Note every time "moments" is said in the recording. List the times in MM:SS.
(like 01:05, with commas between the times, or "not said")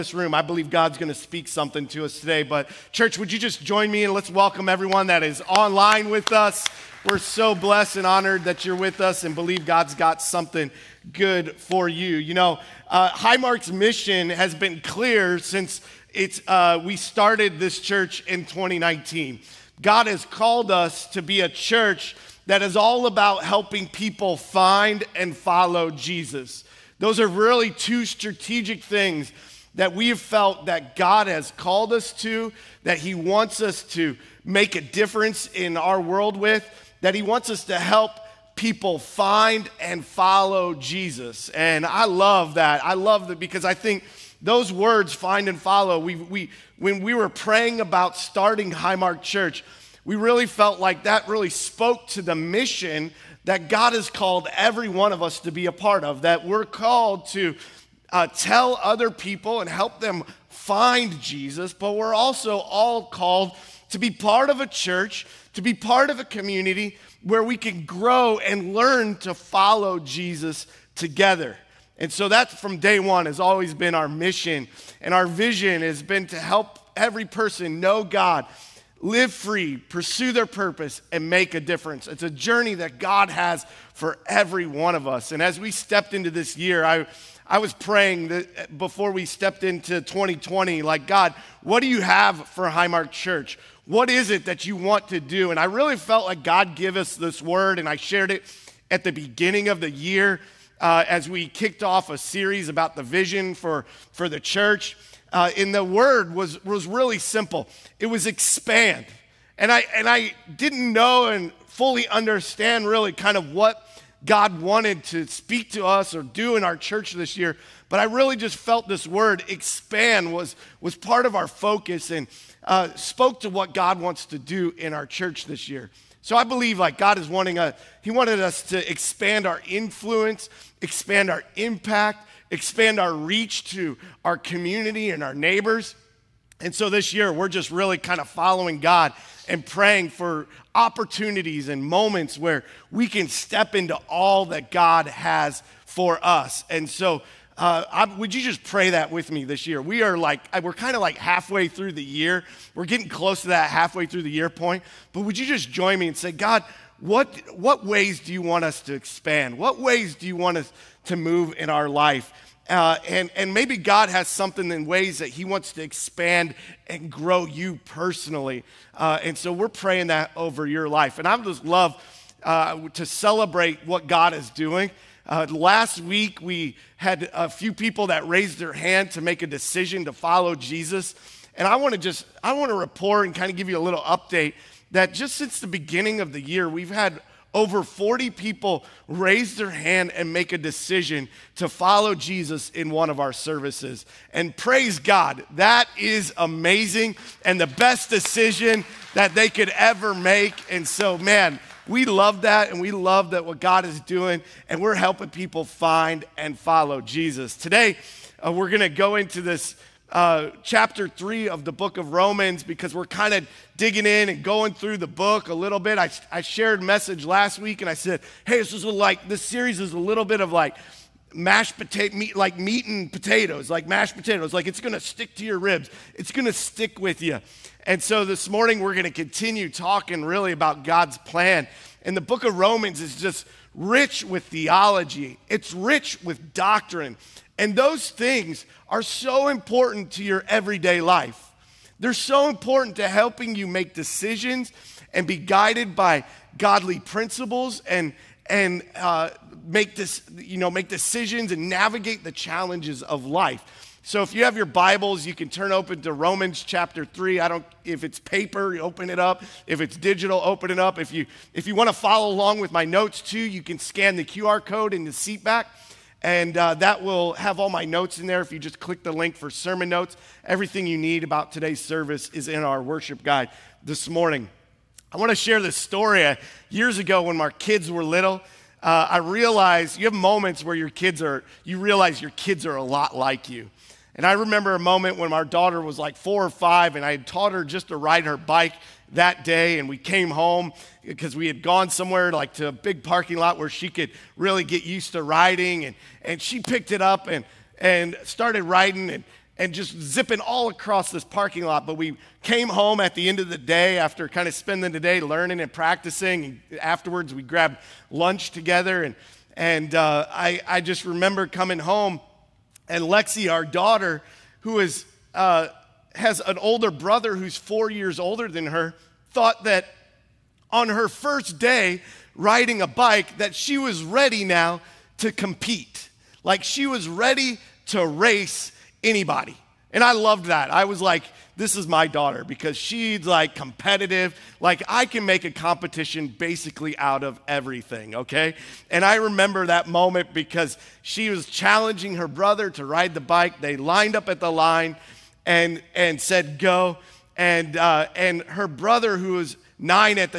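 02:21, 04:40, 04:44, 05:39.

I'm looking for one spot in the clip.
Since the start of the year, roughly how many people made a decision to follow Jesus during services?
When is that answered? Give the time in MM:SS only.
03:07.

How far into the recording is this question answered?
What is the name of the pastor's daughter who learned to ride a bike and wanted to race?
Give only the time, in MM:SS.
05:13.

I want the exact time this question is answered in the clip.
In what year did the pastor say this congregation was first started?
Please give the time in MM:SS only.
00:18.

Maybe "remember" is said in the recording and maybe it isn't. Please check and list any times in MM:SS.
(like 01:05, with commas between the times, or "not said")
04:44, 05:11, 05:39.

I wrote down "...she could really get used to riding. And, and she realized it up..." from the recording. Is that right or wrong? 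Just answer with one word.
wrong.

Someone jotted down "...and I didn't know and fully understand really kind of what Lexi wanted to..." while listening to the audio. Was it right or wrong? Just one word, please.
wrong.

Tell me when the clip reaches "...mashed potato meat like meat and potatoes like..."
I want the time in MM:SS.
03:41.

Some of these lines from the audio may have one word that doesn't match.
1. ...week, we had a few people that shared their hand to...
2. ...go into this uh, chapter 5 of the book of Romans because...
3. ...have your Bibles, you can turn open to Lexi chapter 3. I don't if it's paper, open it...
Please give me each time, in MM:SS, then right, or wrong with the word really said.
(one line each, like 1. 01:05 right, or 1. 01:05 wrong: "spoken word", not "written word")
1. 02:55 wrong: "raised", not "shared"
2. 03:28 wrong: "3", not "5"
3. 04:14 wrong: "Romans", not "Lexi".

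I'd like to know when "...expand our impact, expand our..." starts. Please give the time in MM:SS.
02:10.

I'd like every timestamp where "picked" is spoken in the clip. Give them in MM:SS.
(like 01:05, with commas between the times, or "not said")
04:56.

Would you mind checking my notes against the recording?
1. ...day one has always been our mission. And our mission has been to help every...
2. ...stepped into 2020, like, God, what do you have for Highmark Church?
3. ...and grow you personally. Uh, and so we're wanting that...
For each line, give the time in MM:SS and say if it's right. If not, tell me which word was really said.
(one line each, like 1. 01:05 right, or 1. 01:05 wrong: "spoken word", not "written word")
1. 01:12 wrong: "vision", not "mission"
2. 01:29 right
3. 02:46 wrong: "praying", not "wanting".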